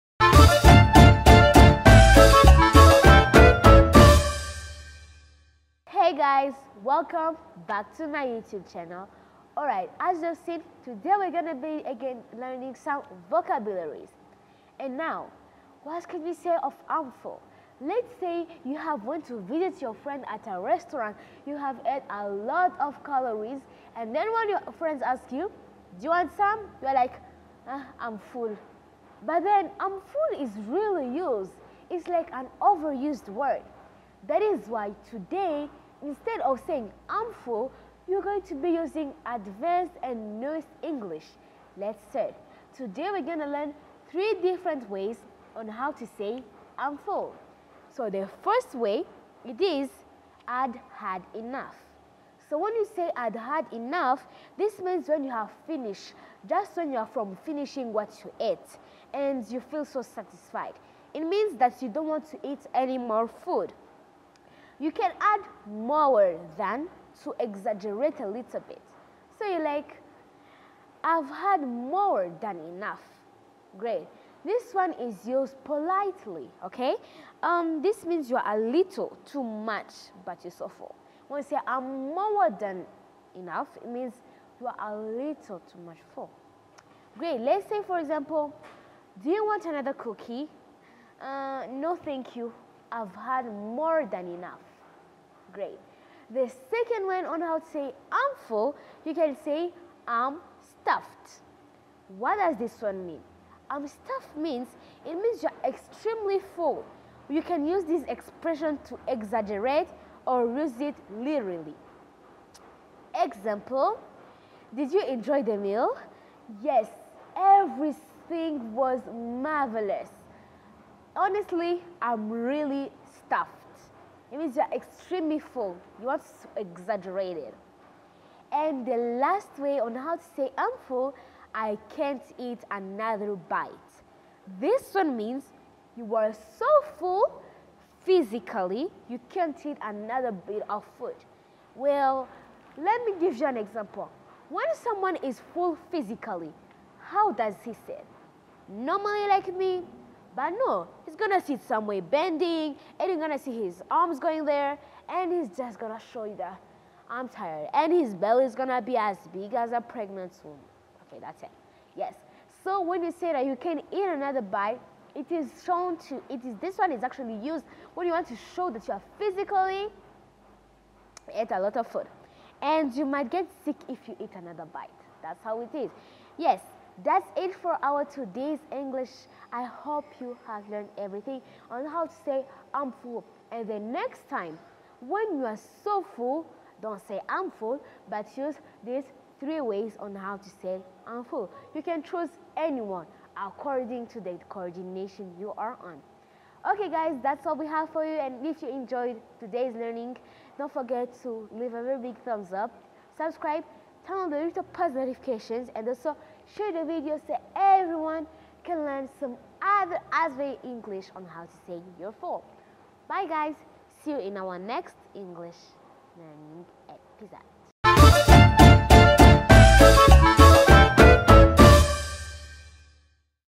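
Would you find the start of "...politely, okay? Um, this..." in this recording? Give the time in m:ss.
1:15.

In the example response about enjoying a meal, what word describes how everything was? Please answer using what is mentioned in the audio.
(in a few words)
marvelous.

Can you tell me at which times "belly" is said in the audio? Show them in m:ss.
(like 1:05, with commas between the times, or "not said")
2:38.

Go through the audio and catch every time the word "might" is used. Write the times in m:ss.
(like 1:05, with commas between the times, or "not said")
2:53.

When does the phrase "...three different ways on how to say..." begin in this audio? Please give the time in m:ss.
0:44.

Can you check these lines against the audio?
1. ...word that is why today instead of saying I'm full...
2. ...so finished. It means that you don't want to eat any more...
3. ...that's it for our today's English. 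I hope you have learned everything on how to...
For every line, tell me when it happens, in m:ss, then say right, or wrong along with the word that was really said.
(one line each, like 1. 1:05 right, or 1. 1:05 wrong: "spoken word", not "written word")
1. 0:33 right
2. 0:59 wrong: "satisfied", not "finished"
3. 2:57 right.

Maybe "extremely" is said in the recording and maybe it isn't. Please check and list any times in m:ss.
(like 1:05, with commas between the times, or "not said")
1:45, 2:04.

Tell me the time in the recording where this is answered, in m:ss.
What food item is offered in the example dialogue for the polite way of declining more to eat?
1:29.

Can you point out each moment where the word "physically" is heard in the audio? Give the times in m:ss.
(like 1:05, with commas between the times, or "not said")
2:18, 2:25, 2:49.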